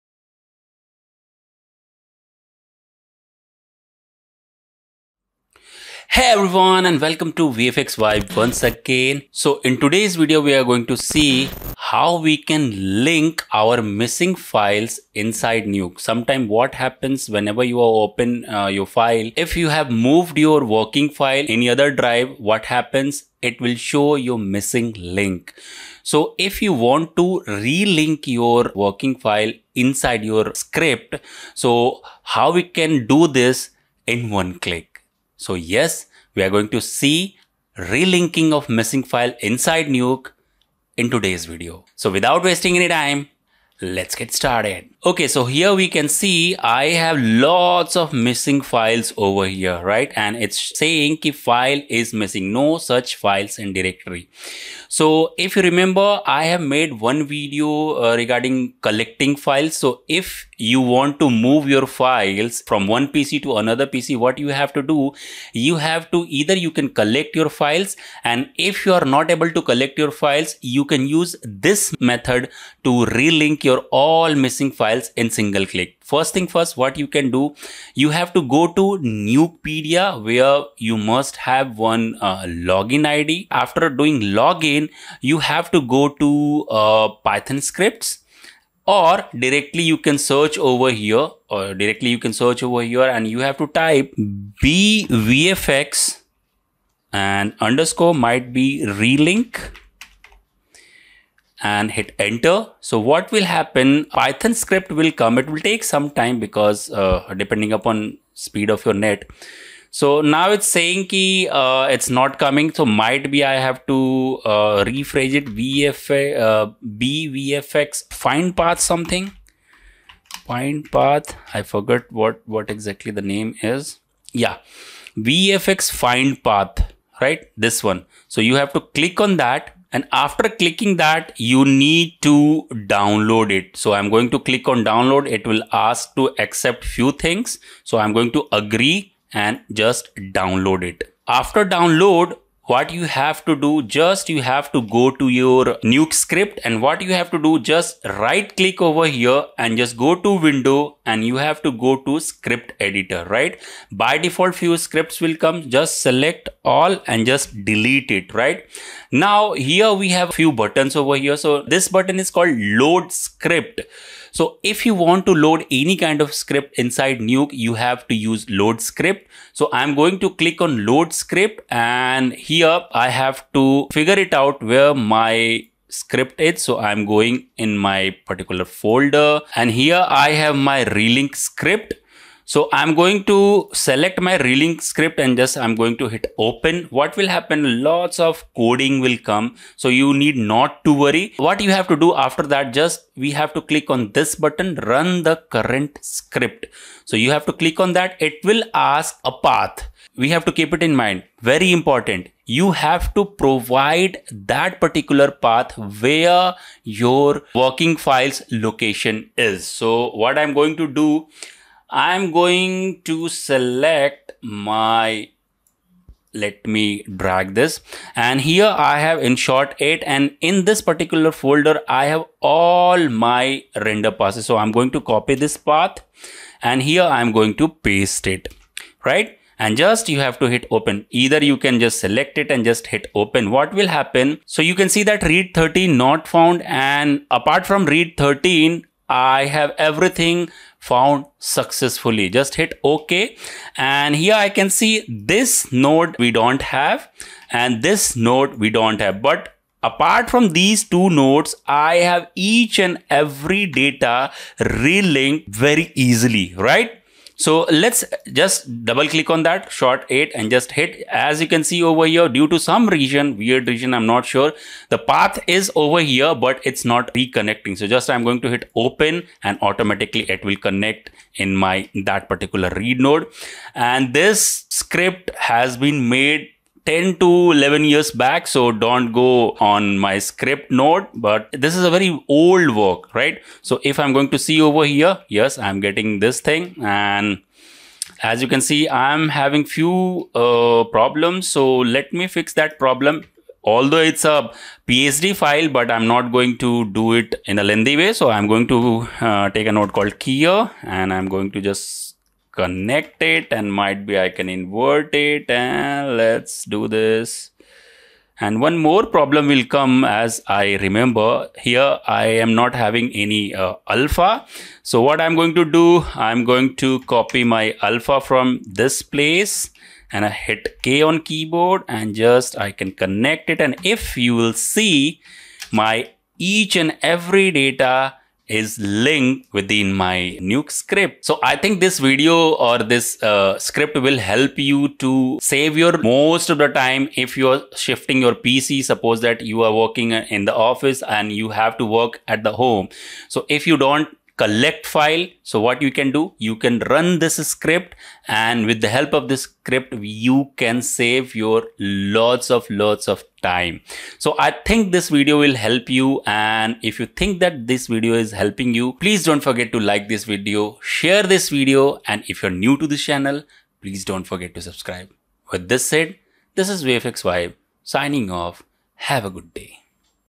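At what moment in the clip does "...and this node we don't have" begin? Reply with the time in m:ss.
4:07.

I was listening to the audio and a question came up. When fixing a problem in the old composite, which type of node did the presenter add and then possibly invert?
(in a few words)
Keyer.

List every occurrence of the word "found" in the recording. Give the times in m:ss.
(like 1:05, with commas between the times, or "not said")
3:56, 4:00.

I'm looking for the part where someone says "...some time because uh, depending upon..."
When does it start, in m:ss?
1:45.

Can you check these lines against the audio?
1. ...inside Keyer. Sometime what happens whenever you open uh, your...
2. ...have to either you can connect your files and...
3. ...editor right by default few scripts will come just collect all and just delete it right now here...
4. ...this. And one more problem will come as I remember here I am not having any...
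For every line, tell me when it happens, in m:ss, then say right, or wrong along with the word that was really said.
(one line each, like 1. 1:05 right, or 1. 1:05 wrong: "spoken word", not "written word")
1. 0:15 wrong: "Nuke", not "Keyer"
2. 1:05 wrong: "collect", not "connect"
3. 2:32 wrong: "select", not "collect"
4. 5:06 right.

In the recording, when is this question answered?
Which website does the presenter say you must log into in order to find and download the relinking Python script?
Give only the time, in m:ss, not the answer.
1:19.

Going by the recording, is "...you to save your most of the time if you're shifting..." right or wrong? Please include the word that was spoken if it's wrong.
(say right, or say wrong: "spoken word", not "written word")
right.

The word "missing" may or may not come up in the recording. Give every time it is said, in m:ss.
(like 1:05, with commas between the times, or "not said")
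0:13, 0:24, 0:38, 0:48, 0:52, 1:14.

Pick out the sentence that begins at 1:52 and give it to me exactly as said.
So might be I have to uh, rephrase it VFA, uh, vfx find path something.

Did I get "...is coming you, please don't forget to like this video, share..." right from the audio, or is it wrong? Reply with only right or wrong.
wrong.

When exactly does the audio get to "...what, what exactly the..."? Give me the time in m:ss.
2:02.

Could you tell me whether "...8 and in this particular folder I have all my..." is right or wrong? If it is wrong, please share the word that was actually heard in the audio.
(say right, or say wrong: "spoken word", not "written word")
right.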